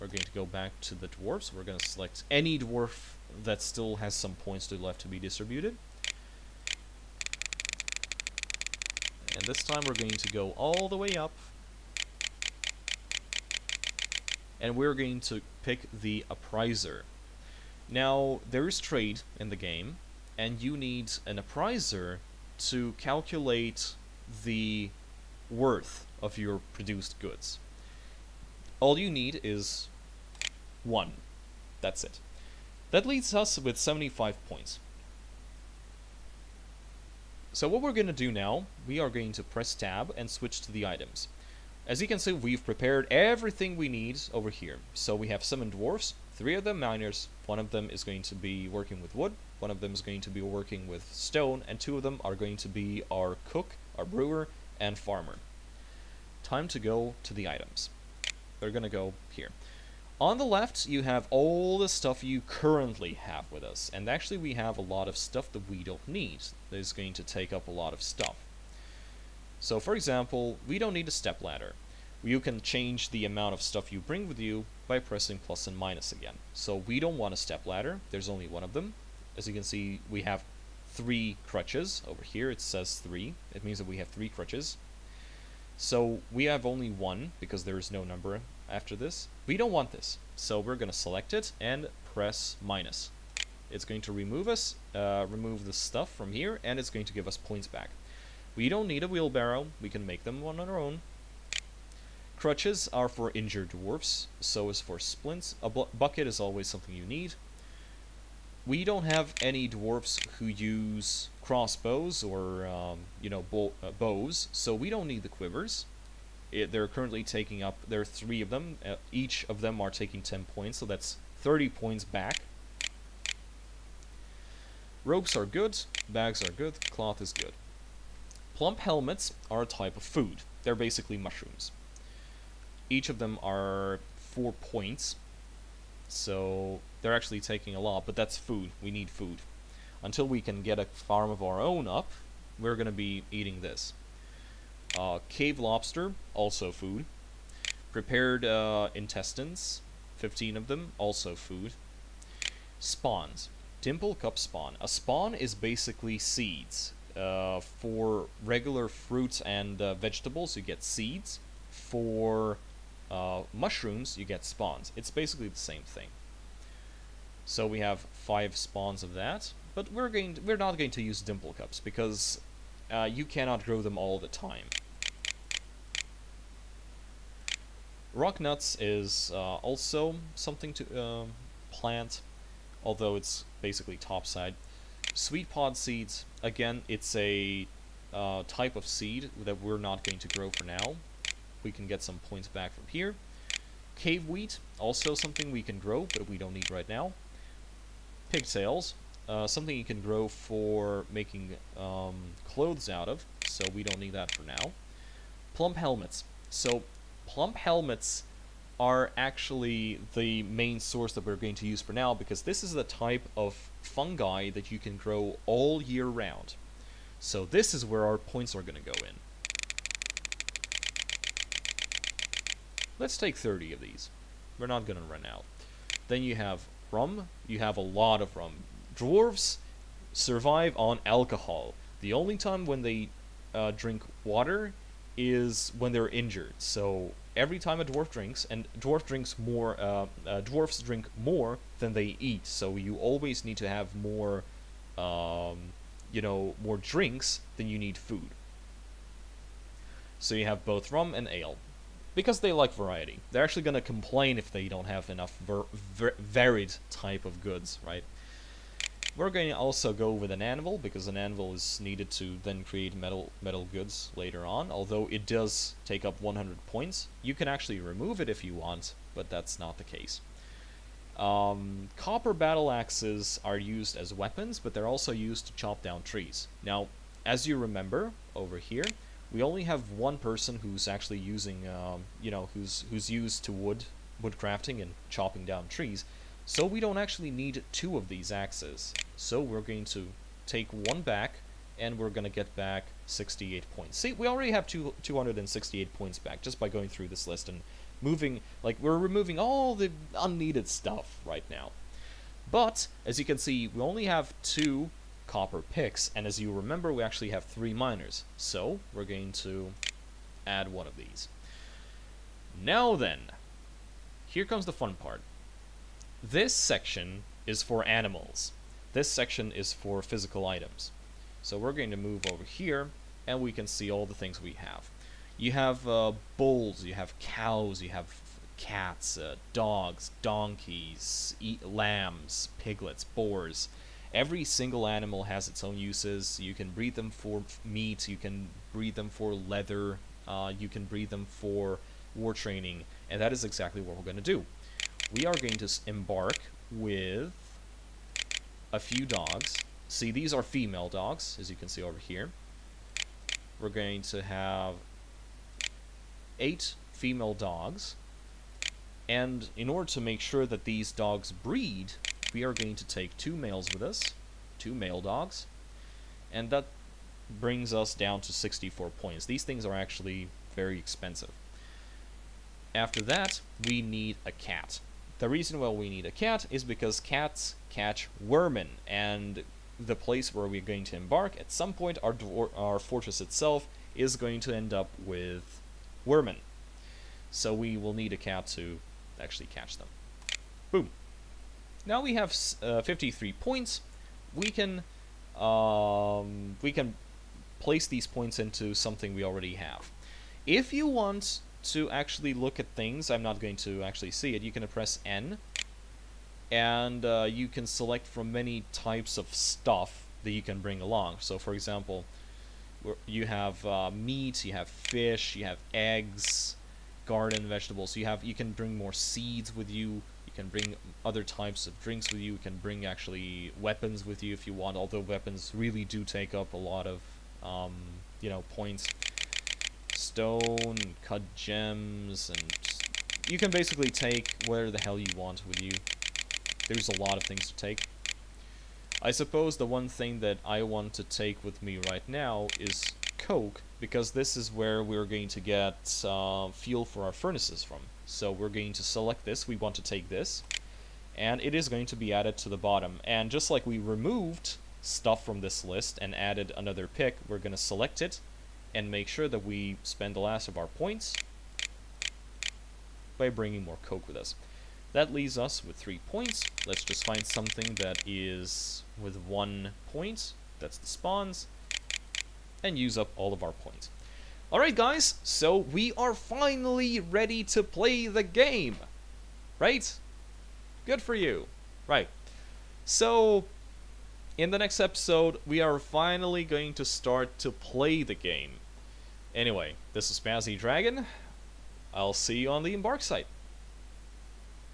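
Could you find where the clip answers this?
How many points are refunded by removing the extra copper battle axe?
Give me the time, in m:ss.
4:53.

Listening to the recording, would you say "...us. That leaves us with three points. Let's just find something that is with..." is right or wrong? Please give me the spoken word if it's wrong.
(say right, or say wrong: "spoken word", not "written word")
right.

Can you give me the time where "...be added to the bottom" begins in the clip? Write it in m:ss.
7:31.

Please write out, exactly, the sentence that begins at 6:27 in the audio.
So we will need a cat to actually catch them.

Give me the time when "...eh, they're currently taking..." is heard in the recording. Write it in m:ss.
1:56.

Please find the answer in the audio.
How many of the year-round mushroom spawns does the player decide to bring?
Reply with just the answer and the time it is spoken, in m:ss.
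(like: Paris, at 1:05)
30, at 3:43.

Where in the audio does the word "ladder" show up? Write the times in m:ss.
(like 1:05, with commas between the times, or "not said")
1:11, 1:17.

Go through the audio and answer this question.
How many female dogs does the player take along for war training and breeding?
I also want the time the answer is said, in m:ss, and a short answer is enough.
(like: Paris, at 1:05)
8, at 5:56.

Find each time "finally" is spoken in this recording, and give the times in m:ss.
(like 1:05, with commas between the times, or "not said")
7:56, 8:05.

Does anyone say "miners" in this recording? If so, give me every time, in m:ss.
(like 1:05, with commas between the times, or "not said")
0:46, 5:07.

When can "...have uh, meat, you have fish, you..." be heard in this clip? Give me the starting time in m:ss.
6:53.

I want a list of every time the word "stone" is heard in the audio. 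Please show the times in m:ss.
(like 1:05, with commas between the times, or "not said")
0:51, 7:09.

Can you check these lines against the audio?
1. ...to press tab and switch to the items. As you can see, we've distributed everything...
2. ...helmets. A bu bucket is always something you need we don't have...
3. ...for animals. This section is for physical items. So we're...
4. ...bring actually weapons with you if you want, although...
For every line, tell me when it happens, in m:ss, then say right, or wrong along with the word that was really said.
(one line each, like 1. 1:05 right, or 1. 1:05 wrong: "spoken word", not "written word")
1. 0:39 wrong: "prepared", not "distributed"
2. 1:44 wrong: "splints", not "helmets"
3. 5:17 right
4. 7:02 right.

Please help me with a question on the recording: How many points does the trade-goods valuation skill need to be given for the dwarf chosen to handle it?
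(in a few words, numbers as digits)
1.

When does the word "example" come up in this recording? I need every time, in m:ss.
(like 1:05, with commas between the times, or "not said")
1:09, 6:51.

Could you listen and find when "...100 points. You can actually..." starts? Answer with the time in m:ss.
4:26.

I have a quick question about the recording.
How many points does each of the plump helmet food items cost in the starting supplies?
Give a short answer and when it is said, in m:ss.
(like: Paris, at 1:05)
4, at 2:14.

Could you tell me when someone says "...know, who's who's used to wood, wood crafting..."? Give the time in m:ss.
4:42.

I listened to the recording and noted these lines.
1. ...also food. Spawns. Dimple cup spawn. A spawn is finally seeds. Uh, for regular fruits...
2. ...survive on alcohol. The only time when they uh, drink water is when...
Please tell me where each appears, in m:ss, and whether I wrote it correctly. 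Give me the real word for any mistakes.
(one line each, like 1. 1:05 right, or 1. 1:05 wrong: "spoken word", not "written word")
1. 2:30 wrong: "basically", not "finally"
2. 3:50 right.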